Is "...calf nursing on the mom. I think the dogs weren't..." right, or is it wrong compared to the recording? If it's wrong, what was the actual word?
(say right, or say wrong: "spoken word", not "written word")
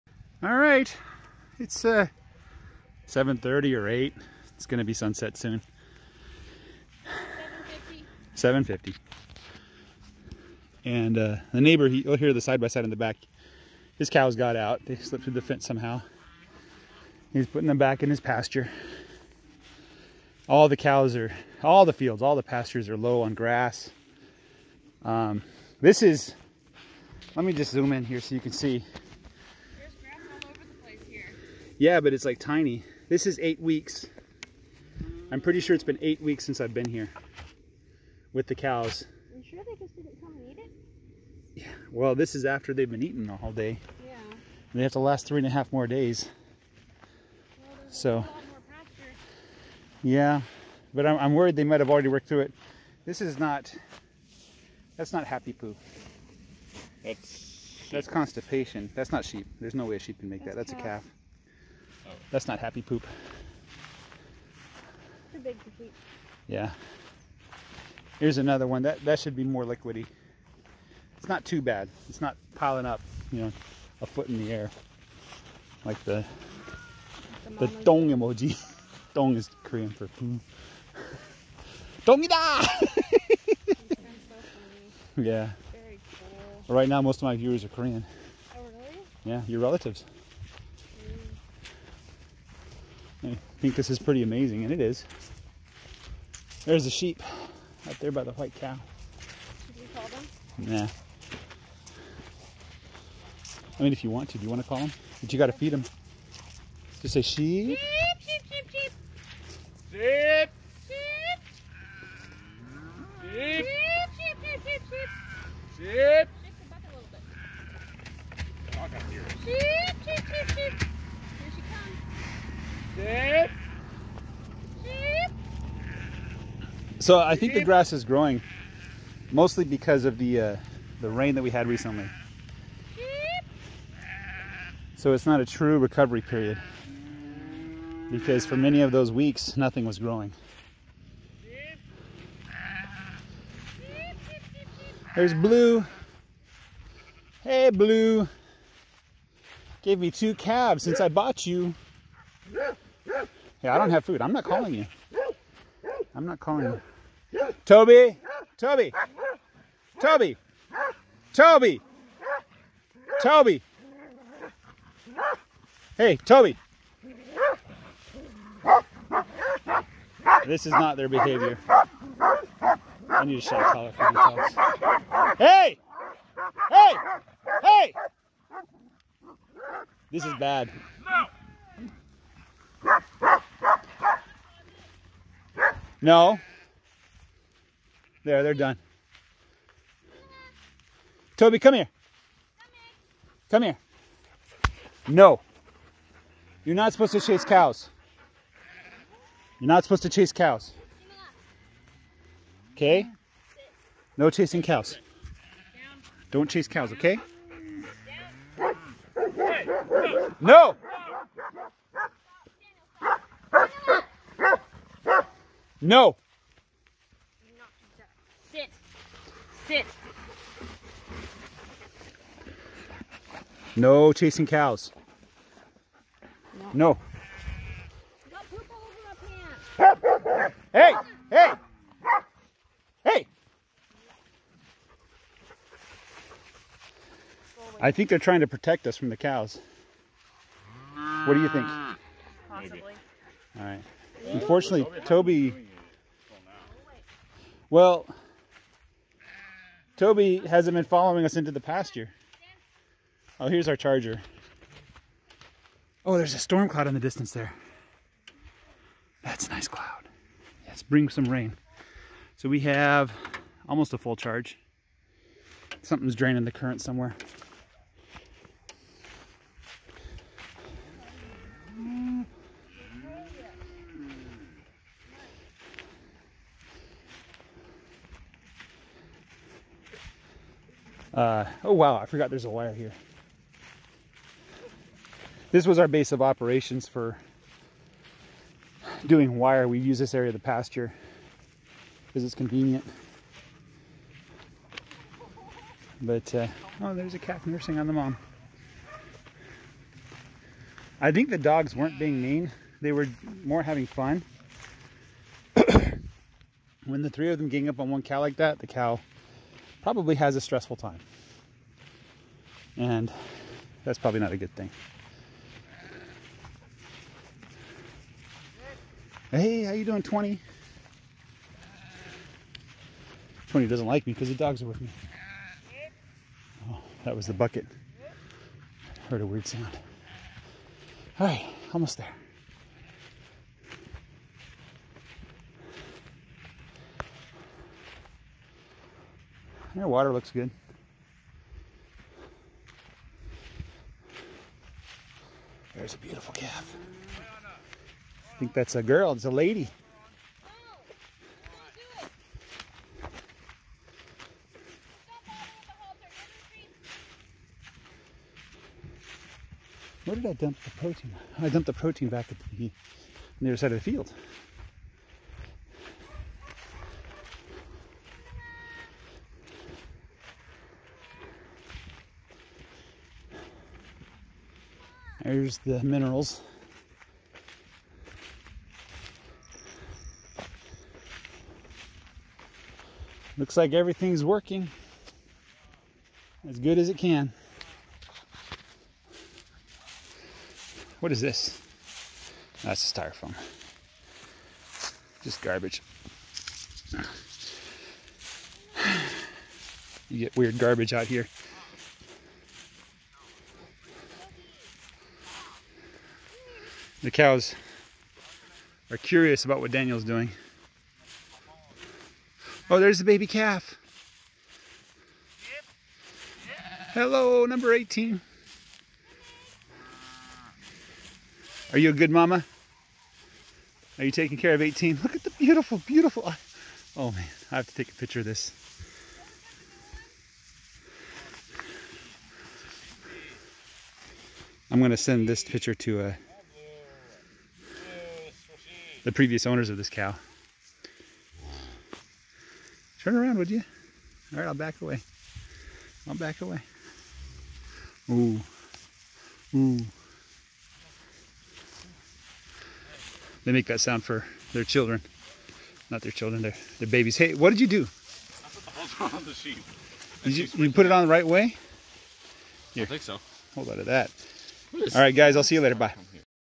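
right.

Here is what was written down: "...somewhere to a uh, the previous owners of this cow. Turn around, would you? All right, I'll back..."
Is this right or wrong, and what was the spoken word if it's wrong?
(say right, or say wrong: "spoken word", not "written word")
wrong: "picture", not "somewhere".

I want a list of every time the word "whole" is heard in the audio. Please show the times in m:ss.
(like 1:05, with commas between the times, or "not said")
0:43.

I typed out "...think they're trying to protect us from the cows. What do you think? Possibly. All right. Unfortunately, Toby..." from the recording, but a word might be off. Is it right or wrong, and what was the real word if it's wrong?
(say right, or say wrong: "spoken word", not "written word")
right.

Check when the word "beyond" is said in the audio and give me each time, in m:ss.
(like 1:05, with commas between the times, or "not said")
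not said.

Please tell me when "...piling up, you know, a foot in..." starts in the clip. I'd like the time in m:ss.
1:12.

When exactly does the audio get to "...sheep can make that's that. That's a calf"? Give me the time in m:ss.
0:59.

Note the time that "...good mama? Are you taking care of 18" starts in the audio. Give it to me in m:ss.
7:01.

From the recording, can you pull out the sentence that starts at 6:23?
Looks like everything's working as good as it can.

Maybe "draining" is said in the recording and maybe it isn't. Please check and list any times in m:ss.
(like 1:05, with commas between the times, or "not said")
4:26.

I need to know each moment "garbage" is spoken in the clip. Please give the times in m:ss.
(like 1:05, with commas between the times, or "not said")
6:35, 6:40.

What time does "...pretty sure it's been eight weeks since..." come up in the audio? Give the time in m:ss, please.
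0:35.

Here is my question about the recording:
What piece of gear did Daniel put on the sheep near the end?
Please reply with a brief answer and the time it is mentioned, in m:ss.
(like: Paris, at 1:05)
halter, at 7:38.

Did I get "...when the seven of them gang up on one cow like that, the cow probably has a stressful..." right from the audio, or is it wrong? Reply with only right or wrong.
wrong.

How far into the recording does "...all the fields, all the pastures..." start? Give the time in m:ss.
0:21.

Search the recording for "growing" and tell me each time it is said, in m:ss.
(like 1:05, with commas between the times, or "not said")
2:08, 2:19.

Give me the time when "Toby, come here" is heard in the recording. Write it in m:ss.
3:11.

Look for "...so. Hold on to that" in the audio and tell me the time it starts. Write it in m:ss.
7:43.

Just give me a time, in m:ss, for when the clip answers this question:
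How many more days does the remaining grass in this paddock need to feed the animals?
0:45.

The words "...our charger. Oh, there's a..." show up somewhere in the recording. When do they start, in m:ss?
4:13.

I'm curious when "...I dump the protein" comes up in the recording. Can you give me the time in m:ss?
6:00.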